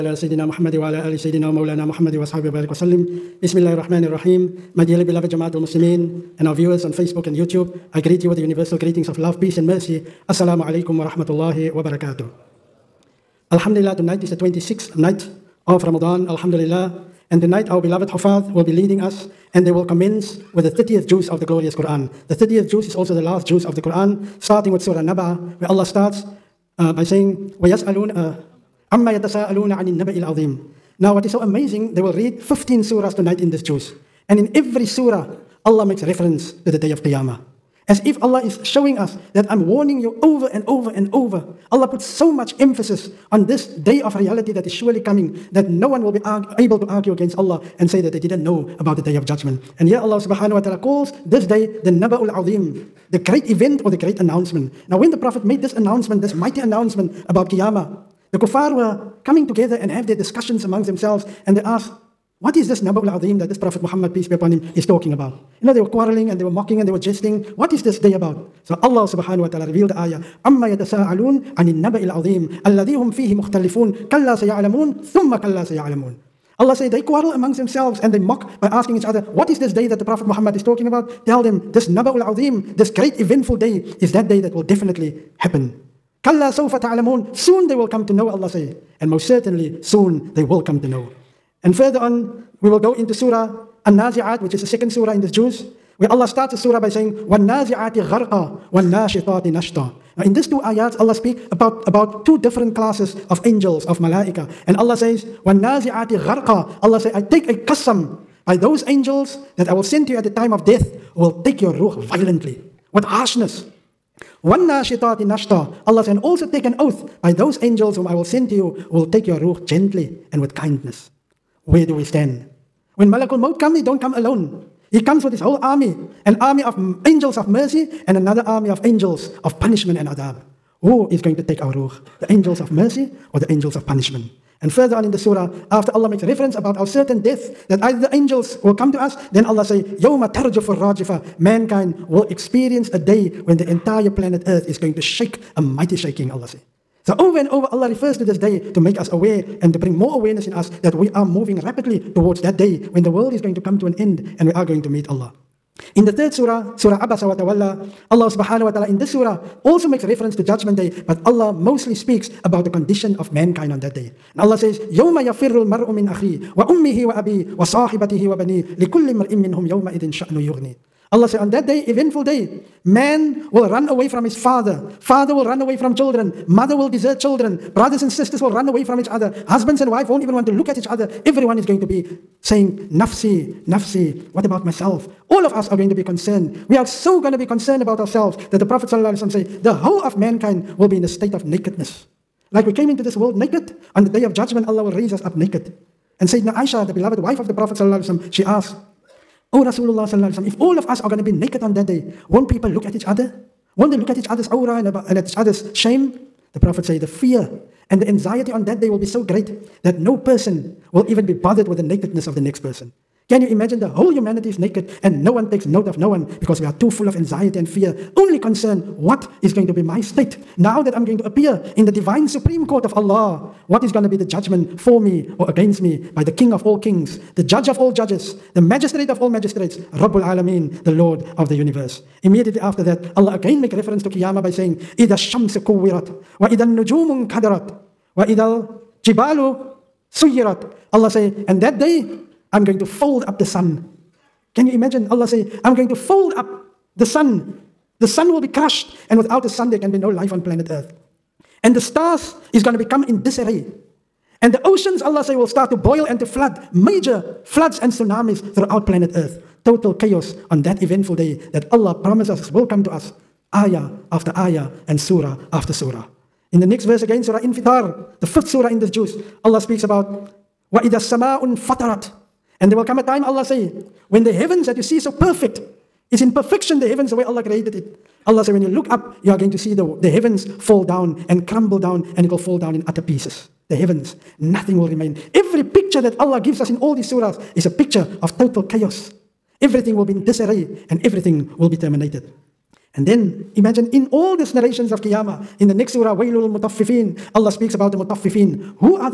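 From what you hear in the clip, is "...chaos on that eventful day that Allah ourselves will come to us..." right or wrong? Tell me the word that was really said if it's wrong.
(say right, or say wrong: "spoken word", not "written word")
wrong: "promises", not "ourselves".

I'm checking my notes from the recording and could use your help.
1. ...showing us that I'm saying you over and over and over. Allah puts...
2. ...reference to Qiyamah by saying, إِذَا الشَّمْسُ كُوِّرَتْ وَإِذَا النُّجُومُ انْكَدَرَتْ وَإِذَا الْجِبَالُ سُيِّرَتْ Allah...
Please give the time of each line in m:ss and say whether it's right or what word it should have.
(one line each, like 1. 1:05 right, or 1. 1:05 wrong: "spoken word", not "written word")
1. 0:38 wrong: "warning", not "saying"
2. 3:53 right.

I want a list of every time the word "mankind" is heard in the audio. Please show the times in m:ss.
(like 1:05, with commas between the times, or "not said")
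2:21, 2:43, 3:10.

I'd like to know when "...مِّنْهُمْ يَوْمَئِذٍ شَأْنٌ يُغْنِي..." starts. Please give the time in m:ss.
2:49.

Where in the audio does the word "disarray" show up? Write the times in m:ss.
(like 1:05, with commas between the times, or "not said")
4:13, 4:50.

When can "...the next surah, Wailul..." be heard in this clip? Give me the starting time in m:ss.
4:55.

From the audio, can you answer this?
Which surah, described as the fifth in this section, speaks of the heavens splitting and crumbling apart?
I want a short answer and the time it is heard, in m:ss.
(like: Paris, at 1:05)
Surah Infitar, at 4:27.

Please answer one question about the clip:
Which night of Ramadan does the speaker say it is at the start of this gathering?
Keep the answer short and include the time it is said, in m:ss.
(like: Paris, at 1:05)
26th, at 0:14.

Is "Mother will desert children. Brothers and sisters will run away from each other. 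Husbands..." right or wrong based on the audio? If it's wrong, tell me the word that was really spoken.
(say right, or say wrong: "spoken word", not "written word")
right.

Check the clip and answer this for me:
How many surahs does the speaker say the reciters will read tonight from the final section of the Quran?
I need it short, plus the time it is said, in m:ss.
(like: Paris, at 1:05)
15, at 0:32.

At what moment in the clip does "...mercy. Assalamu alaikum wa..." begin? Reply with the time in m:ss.
0:09.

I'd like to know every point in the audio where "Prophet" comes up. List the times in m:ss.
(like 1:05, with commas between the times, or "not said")
0:55, 1:03, 1:20, 3:08, 3:17, 3:26.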